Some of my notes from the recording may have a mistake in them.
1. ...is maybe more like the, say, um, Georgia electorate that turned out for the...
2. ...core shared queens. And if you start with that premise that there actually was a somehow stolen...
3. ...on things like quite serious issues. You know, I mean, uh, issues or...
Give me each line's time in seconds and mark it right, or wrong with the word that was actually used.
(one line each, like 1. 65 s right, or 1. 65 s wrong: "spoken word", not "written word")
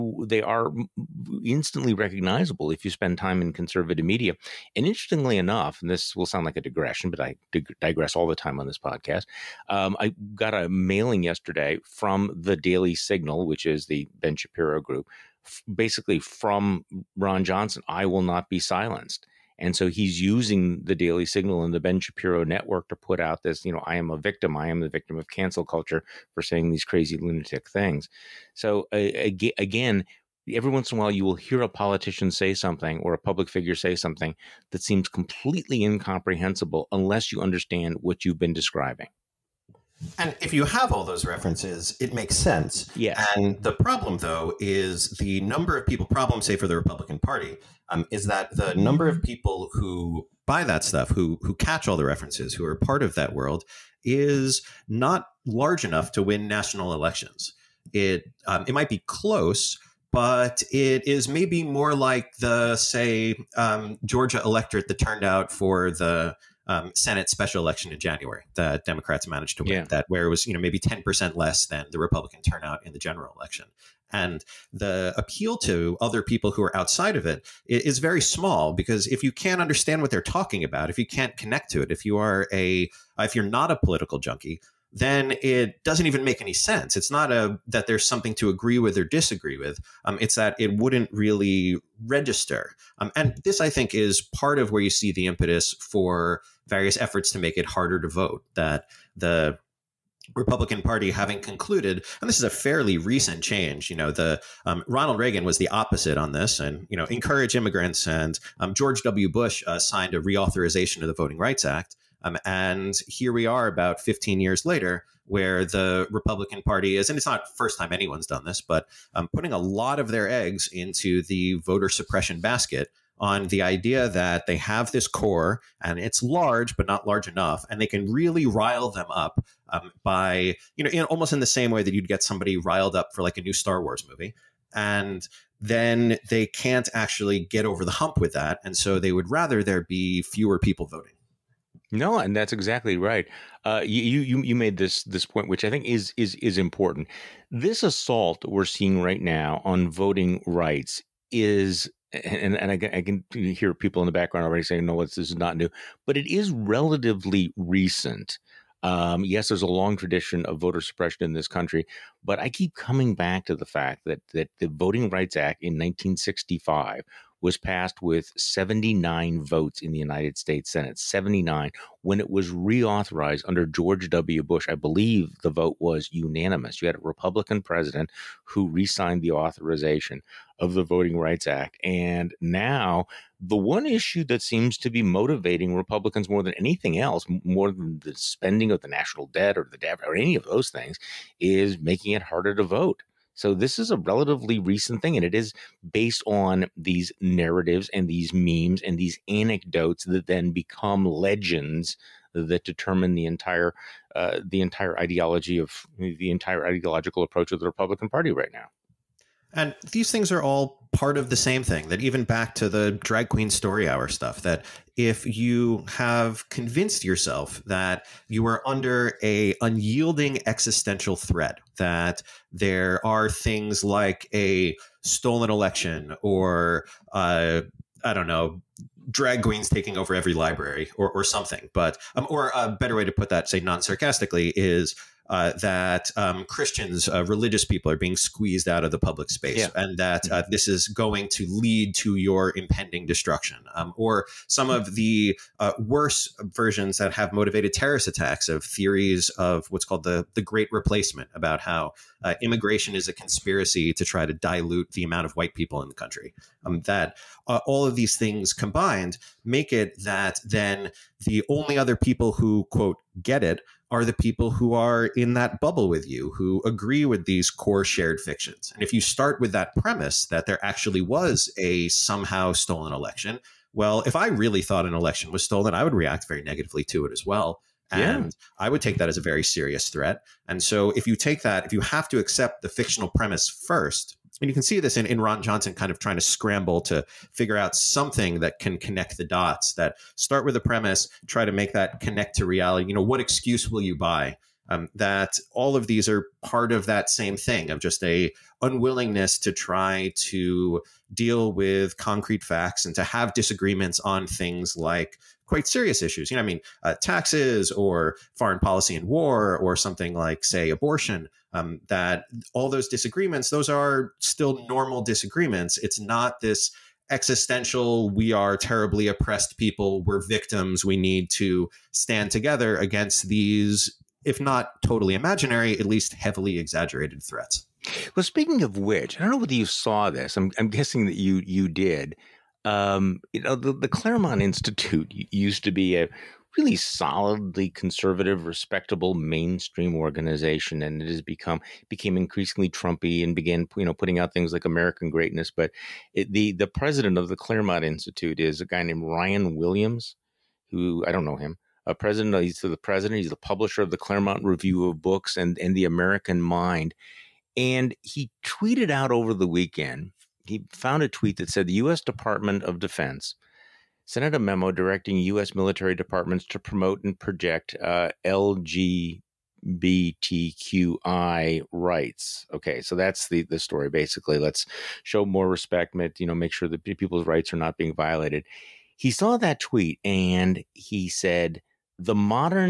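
1. 61 s right
2. 267 s wrong: "fictions", not "queens"
3. 303 s wrong: "taxes", not "issues".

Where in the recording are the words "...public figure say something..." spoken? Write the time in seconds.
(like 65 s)
33 s.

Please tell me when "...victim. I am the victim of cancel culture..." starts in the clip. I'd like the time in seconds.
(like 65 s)
24 s.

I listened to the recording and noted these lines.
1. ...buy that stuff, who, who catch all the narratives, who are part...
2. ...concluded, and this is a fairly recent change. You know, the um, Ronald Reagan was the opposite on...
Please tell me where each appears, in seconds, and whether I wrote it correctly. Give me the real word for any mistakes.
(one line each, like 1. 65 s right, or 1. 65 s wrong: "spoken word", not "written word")
1. 50 s wrong: "references", not "narratives"
2. 101 s right.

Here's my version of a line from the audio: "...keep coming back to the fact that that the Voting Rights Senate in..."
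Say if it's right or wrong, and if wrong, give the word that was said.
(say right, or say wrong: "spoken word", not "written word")
wrong: "Act", not "Senate".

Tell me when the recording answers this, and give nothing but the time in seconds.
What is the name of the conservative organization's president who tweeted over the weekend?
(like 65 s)
349 s.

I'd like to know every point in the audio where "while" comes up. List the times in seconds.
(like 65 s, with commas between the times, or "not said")
31 s.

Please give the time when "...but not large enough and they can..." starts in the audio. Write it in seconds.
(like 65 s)
126 s.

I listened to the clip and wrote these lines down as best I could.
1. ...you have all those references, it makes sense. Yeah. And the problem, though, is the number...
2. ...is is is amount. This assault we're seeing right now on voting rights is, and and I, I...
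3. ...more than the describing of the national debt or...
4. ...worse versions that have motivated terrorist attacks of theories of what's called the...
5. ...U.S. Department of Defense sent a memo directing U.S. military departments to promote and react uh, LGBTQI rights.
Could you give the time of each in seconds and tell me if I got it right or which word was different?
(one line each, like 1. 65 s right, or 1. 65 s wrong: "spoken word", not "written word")
1. 40 s right
2. 145 s wrong: "important", not "amount"
3. 187 s wrong: "spending", not "describing"
4. 245 s right
5. 361 s wrong: "project", not "react".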